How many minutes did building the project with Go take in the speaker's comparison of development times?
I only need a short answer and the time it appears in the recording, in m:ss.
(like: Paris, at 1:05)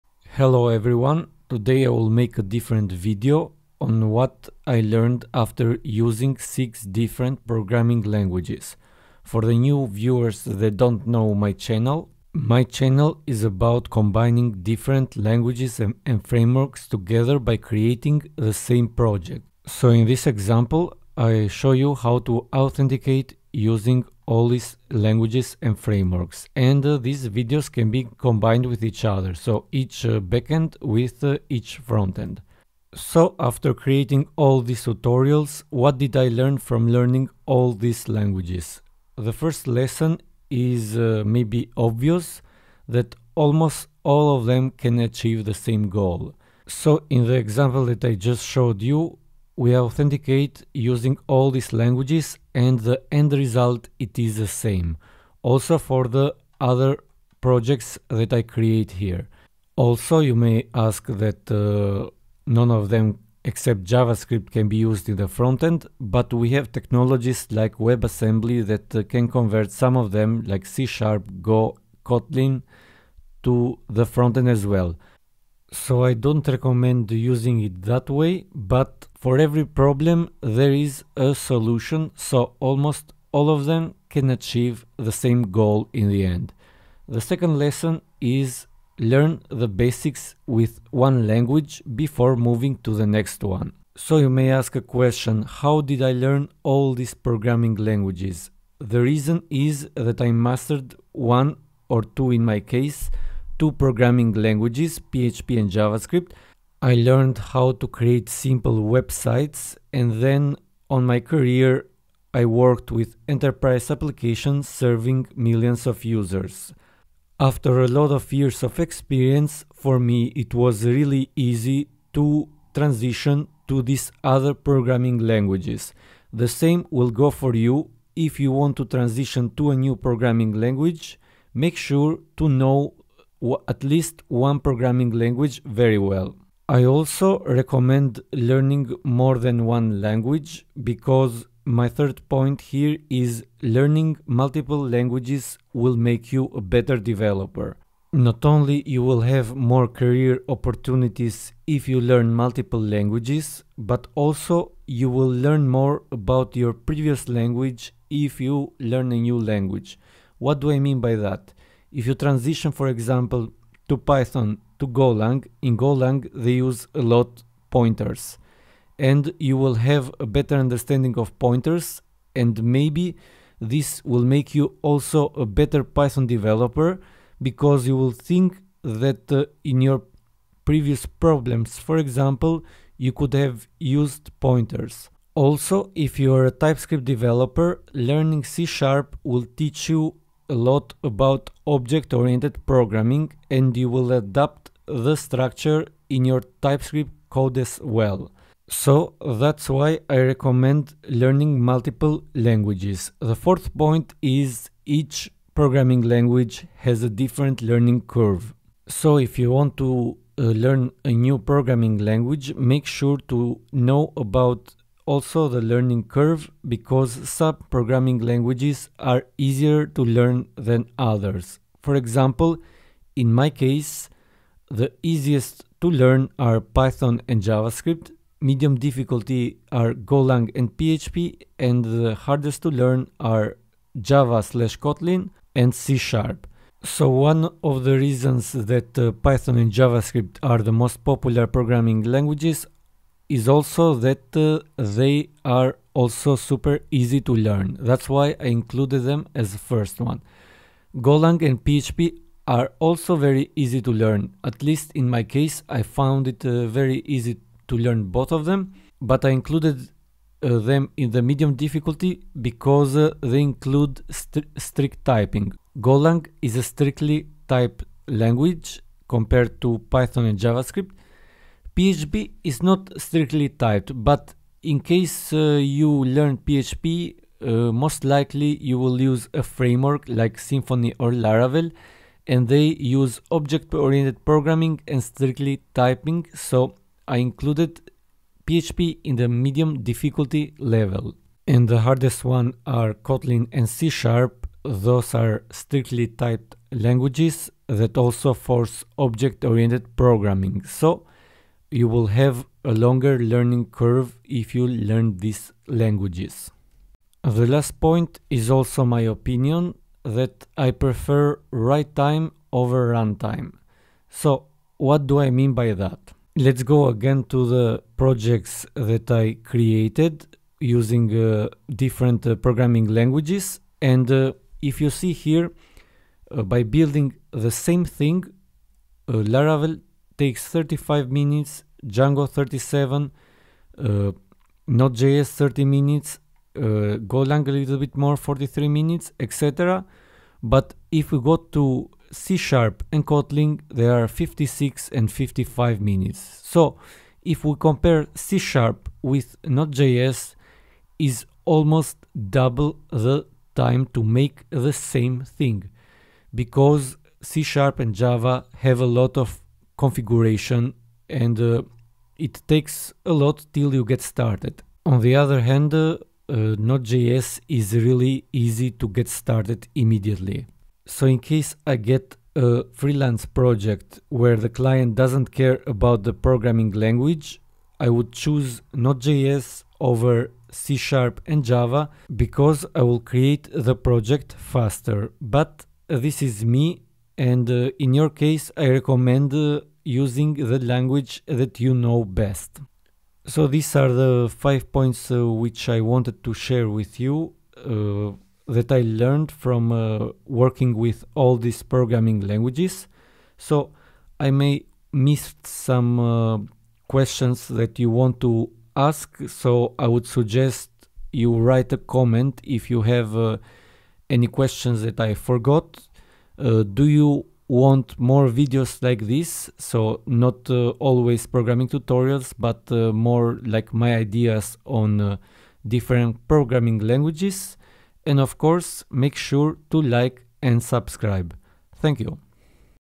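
43 minutes, at 5:38.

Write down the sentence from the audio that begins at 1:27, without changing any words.
The second lesson is learn the basics with one language before moving to the next one.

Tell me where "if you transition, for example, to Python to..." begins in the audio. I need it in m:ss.
2:41.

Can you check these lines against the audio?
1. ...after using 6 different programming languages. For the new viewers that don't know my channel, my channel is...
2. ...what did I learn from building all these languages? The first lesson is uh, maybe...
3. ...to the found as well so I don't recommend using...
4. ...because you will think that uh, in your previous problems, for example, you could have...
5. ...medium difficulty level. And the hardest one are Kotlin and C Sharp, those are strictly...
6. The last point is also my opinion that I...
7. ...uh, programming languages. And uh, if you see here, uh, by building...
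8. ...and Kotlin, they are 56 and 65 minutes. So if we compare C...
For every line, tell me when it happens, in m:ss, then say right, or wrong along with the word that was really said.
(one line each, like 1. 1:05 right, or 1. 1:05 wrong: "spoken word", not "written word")
1. 0:05 right
2. 0:35 wrong: "learning", not "building"
3. 1:13 wrong: "frontend", not "found"
4. 2:57 right
5. 4:49 right
6. 5:07 right
7. 5:22 right
8. 5:42 wrong: "55", not "65".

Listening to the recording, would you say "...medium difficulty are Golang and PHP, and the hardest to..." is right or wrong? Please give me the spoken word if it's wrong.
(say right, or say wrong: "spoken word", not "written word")
right.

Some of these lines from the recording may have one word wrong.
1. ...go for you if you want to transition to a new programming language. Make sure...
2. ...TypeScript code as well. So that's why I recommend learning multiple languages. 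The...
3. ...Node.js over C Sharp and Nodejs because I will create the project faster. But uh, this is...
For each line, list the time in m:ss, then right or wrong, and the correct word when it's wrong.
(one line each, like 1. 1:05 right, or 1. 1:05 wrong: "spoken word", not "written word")
1. 2:07 right
2. 3:16 right
3. 6:18 wrong: "Java", not "Nodejs".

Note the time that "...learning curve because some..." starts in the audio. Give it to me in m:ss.
3:35.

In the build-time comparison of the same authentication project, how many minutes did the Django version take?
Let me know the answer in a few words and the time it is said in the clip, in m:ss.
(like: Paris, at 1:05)
37, at 5:32.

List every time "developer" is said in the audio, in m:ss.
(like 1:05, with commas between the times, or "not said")
2:26, 2:56, 3:07.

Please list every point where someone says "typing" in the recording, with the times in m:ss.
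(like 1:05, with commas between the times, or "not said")
4:25, 4:45.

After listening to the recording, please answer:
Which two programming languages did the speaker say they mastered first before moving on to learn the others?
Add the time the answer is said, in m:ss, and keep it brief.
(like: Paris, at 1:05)
PHP and JavaScript, at 1:45.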